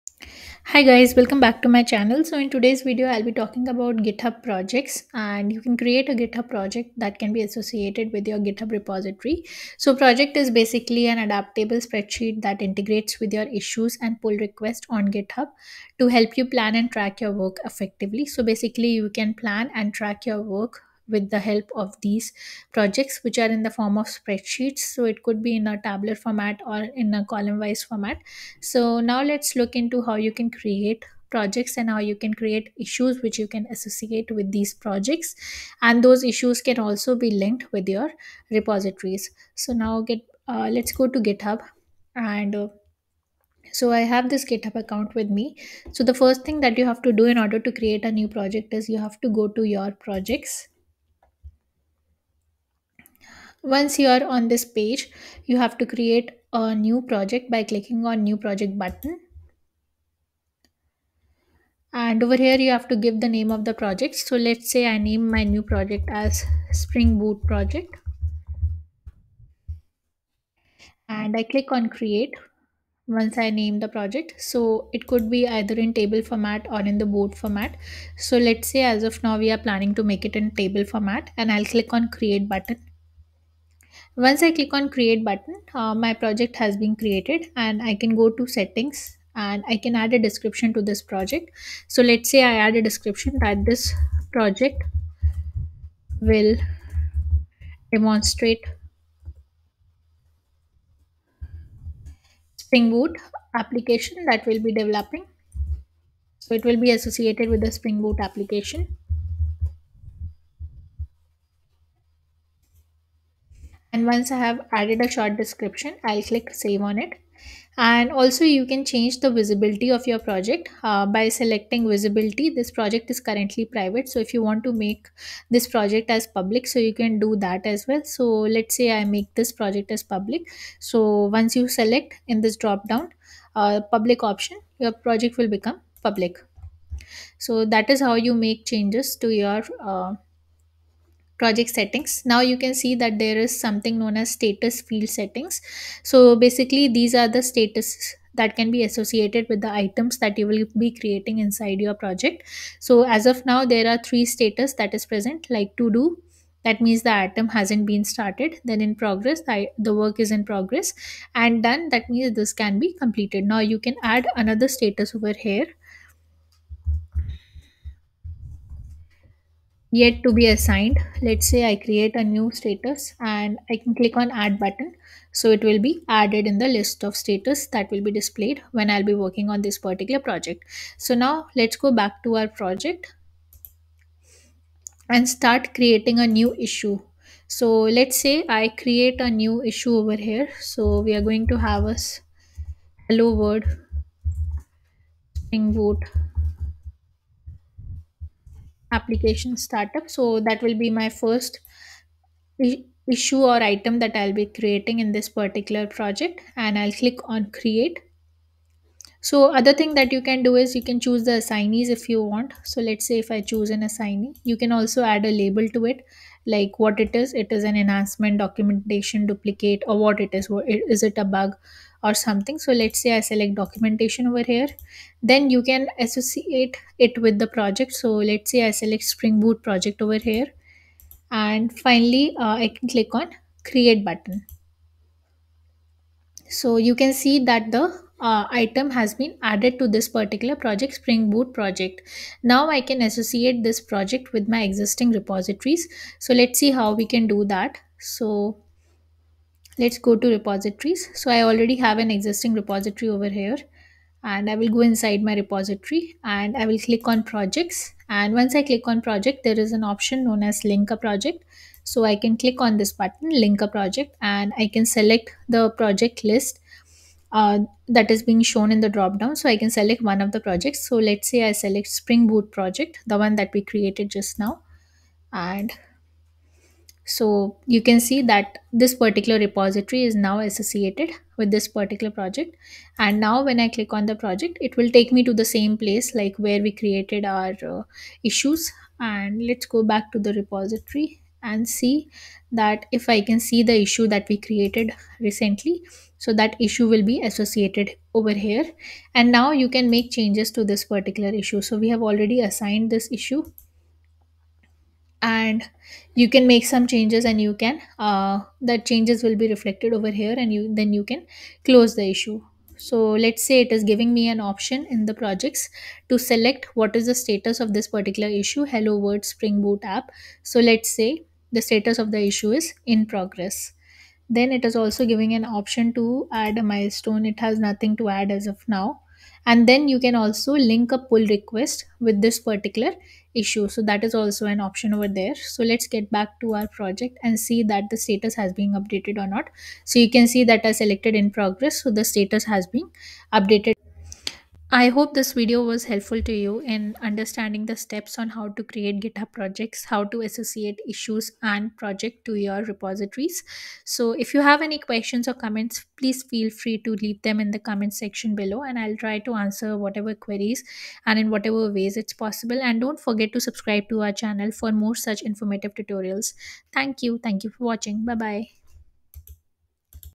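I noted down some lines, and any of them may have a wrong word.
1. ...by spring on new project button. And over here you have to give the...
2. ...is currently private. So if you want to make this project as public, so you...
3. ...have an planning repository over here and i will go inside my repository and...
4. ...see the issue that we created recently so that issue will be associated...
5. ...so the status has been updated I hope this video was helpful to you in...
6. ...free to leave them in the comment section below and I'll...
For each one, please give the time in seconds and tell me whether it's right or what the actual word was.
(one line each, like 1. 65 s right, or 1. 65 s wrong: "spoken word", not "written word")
1. 57 s wrong: "clicking", not "spring"
2. 123 s right
3. 251 s wrong: "existing", not "planning"
4. 293 s right
5. 341 s right
6. 356 s right.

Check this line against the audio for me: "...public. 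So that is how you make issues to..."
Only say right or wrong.
wrong.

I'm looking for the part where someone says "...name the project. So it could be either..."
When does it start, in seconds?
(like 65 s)
73 s.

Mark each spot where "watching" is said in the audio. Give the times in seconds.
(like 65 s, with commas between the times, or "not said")
367 s.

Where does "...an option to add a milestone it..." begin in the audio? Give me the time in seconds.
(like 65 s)
325 s.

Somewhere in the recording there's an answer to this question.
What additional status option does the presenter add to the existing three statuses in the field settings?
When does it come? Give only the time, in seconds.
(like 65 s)
169 s.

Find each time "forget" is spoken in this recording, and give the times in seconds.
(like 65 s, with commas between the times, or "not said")
362 s.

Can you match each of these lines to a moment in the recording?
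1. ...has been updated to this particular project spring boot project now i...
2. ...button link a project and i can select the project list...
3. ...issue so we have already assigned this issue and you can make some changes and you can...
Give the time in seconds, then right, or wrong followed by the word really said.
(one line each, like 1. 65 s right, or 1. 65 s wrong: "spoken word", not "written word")
1. 238 s wrong: "added", not "updated"
2. 262 s right
3. 301 s right.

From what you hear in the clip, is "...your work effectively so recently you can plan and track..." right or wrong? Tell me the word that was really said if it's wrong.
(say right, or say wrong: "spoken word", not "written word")
wrong: "basically", not "recently".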